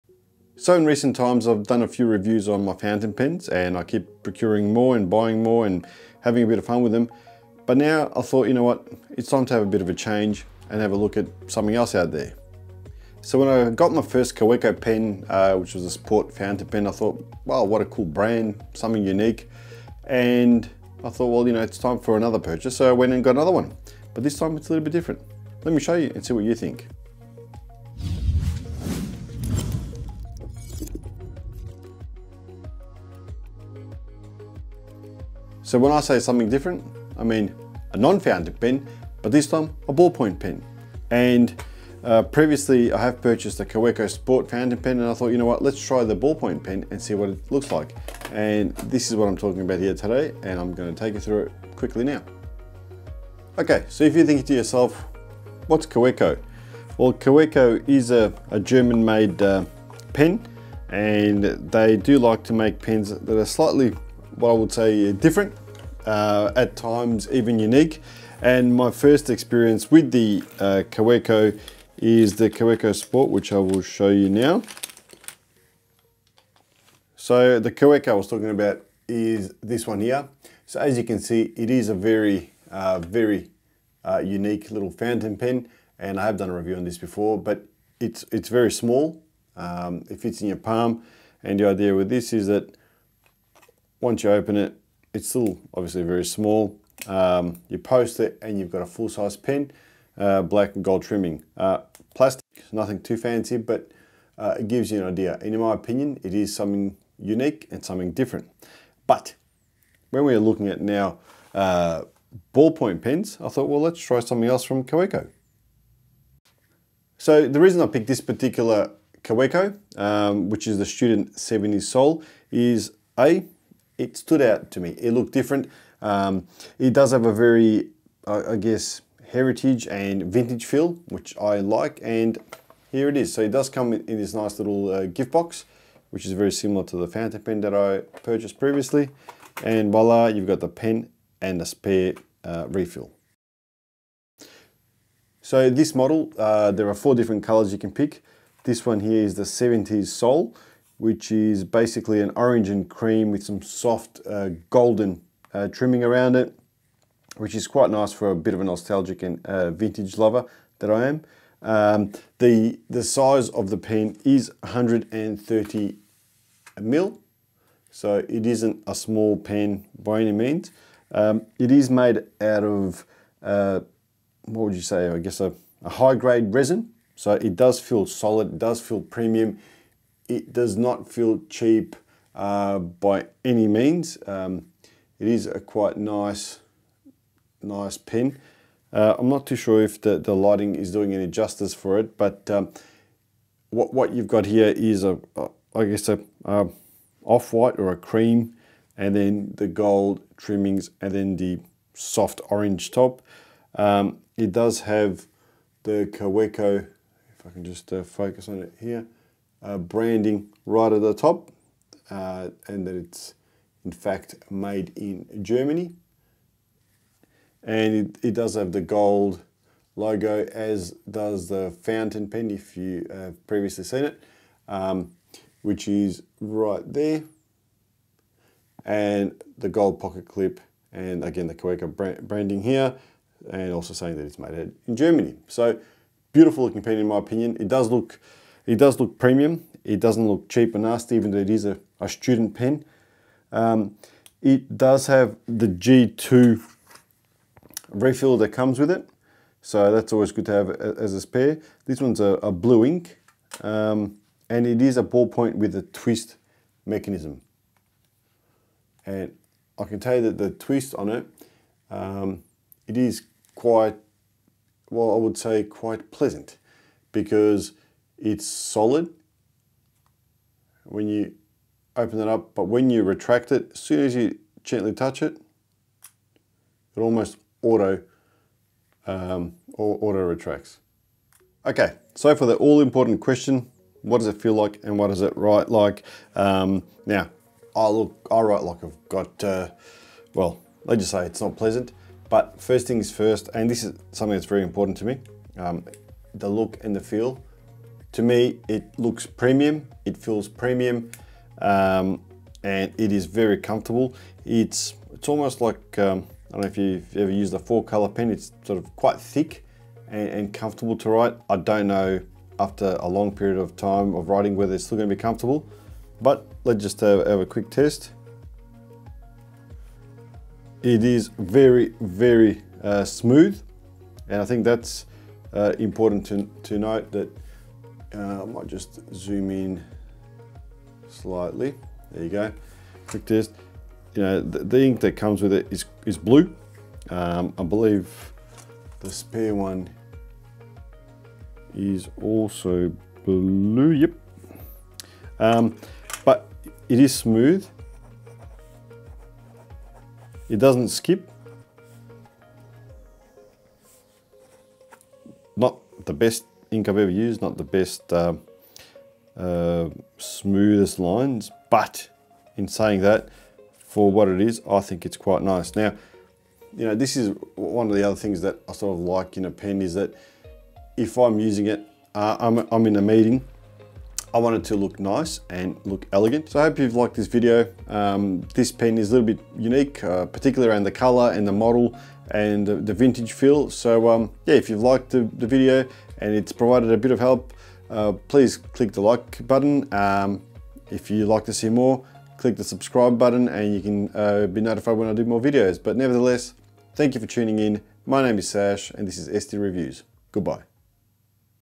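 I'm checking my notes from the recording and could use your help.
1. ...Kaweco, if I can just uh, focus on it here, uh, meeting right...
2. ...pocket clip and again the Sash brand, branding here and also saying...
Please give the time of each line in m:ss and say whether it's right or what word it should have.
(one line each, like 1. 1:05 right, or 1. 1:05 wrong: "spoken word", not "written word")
1. 3:26 wrong: "branding", not "meeting"
2. 3:49 wrong: "Kaweco", not "Sash".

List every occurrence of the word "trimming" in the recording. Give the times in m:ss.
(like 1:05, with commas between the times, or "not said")
1:41, 2:35, 3:20.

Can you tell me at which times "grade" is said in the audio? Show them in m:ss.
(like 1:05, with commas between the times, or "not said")
2:56.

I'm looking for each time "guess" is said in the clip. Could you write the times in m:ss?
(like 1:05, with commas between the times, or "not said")
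2:08, 2:55, 3:15.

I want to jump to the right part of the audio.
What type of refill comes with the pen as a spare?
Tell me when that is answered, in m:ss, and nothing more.
4:05.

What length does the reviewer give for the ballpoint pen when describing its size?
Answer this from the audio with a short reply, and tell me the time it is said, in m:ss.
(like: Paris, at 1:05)
130 mil, at 2:44.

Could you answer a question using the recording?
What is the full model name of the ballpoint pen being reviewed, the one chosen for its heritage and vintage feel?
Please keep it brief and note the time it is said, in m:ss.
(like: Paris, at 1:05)
Student 70 Soul, at 2:00.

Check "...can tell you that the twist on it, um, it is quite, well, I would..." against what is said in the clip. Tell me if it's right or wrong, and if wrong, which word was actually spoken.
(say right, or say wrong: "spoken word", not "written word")
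right.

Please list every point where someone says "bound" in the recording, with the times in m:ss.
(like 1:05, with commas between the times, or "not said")
not said.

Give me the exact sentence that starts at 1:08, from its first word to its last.
And my first experience with the uh, Kaweco is the Kaweco Sport, which I will show you now.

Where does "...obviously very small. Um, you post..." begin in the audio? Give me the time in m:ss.
1:35.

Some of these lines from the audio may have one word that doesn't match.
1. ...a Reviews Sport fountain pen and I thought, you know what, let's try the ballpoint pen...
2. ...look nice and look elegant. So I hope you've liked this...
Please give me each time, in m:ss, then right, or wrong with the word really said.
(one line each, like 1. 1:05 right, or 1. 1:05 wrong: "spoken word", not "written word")
1. 0:43 wrong: "Kaweco", not "Reviews"
2. 6:14 right.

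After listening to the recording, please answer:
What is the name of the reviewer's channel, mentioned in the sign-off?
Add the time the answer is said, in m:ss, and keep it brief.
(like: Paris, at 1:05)
ST Reviews, at 6:39.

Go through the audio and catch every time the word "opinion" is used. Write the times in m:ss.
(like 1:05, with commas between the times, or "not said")
1:45, 3:57.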